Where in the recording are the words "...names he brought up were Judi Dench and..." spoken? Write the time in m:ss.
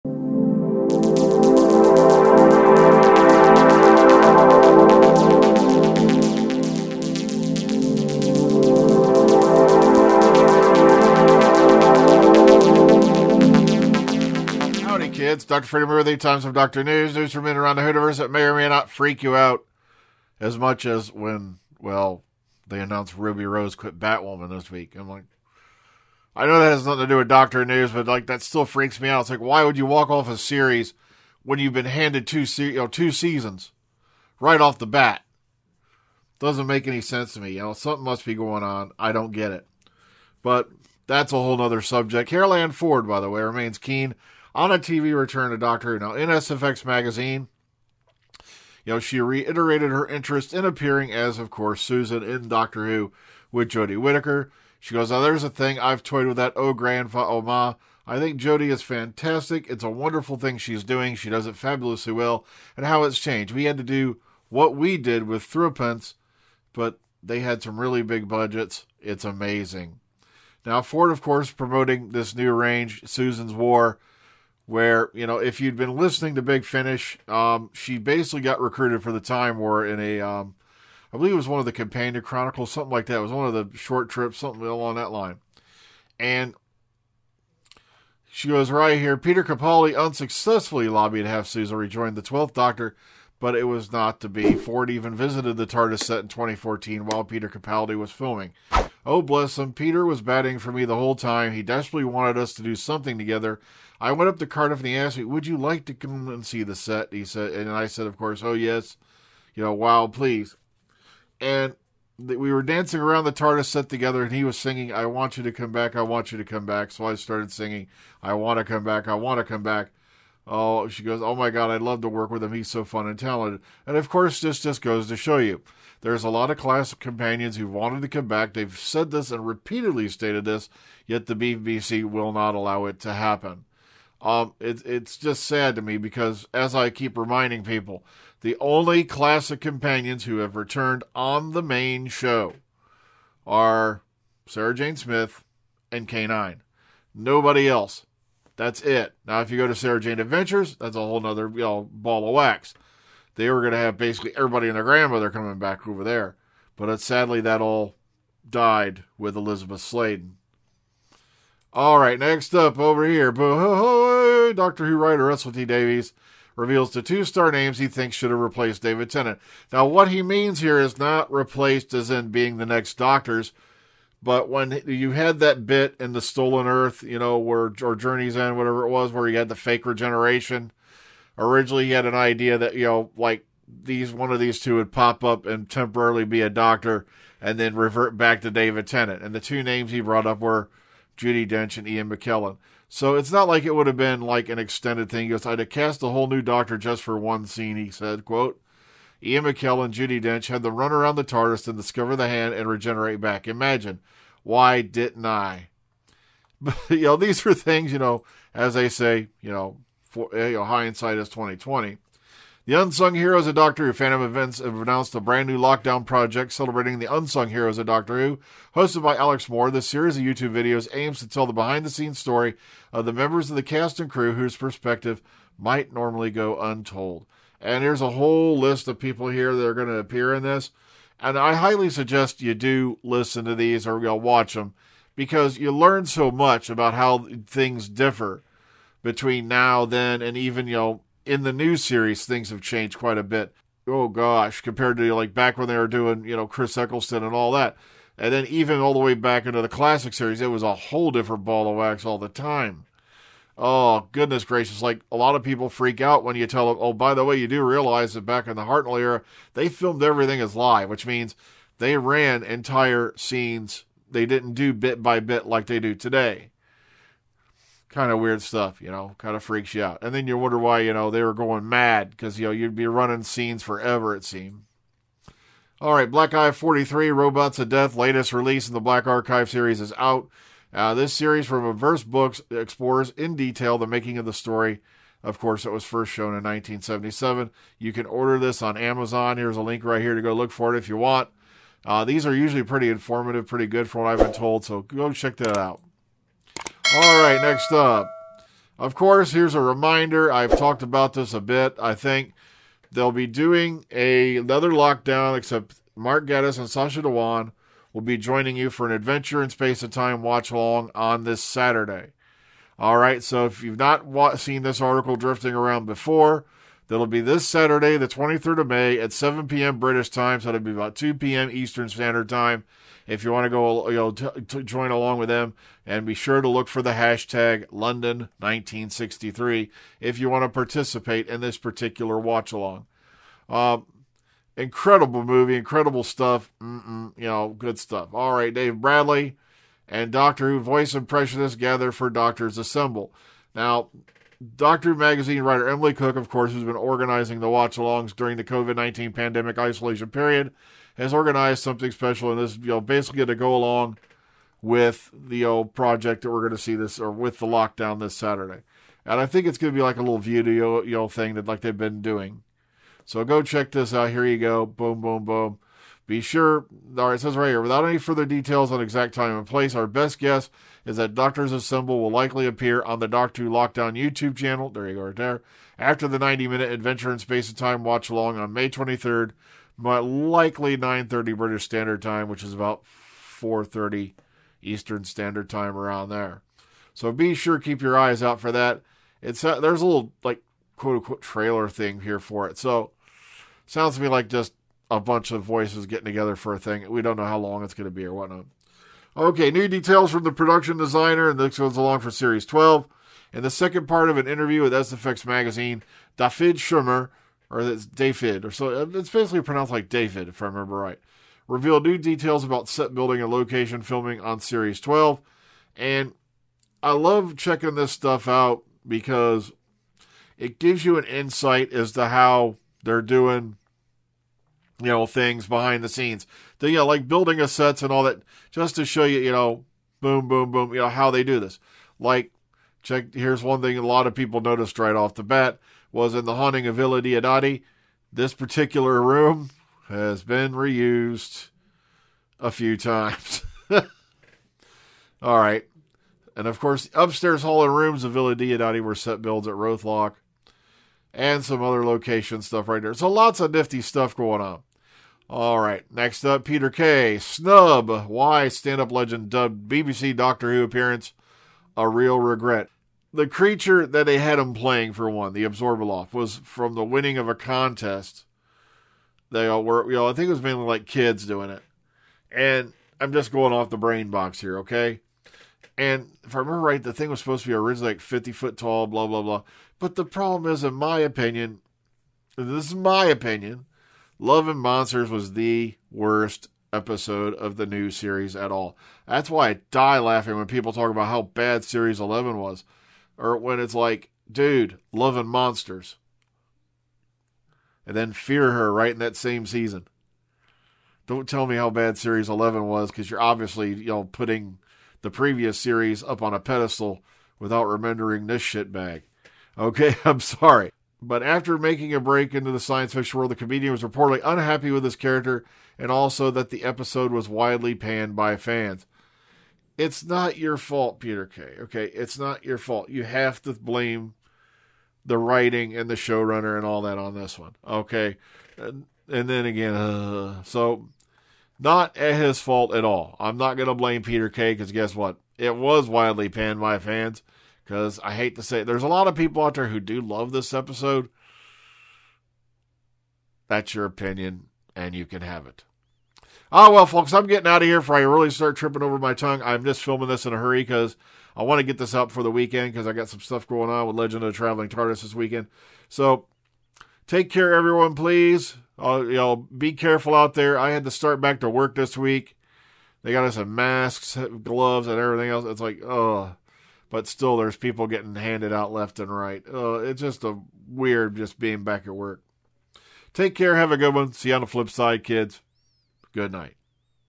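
3:09.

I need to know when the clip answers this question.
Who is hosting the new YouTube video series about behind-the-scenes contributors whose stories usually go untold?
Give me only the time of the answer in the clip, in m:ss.
3:39.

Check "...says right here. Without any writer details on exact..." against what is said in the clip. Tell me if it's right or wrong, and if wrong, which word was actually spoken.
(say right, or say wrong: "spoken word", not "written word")
wrong: "further", not "writer".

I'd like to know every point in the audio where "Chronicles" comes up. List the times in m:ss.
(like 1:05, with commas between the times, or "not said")
1:22.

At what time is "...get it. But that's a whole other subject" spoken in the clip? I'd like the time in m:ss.
0:39.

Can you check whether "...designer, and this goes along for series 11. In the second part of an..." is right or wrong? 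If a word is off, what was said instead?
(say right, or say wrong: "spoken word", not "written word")
wrong: "12", not "11".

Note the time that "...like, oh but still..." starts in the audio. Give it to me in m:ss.
9:25.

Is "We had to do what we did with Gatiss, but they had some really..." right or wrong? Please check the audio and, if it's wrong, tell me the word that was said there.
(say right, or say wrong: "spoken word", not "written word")
wrong: "Threepence", not "Gatiss".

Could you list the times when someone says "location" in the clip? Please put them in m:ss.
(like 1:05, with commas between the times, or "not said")
6:53, 7:31.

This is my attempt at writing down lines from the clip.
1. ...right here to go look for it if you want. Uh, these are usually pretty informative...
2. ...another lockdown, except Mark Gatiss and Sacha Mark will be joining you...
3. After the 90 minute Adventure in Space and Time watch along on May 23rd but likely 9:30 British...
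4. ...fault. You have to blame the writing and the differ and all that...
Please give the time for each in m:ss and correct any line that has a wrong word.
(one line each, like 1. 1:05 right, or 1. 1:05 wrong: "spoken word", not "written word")
1. 4:49 right
2. 5:04 wrong: "Dhawan", not "Mark"
3. 6:15 right
4. 8:42 wrong: "showrunner", not "differ".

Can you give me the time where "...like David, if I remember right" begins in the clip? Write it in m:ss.
6:49.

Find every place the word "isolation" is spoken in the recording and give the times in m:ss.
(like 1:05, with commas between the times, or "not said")
5:49.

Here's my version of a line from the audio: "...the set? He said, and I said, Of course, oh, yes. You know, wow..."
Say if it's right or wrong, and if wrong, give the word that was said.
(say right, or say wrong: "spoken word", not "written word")
right.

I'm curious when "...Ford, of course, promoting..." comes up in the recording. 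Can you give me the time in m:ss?
1:10.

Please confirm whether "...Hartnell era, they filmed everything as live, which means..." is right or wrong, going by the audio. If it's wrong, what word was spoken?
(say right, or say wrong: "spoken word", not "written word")
right.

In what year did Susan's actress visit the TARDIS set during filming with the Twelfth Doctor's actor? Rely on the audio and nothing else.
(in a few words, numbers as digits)
2014.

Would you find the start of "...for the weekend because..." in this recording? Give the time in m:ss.
9:12.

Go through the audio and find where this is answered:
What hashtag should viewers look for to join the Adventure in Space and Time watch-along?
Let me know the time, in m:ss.
5:27.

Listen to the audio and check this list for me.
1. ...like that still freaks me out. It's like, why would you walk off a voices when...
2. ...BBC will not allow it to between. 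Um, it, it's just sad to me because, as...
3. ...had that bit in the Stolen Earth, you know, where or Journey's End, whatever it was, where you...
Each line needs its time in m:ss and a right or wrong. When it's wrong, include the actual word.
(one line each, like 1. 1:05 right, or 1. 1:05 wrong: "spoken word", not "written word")
1. 0:28 wrong: "series", not "voices"
2. 2:11 wrong: "happen", not "between"
3. 2:55 right.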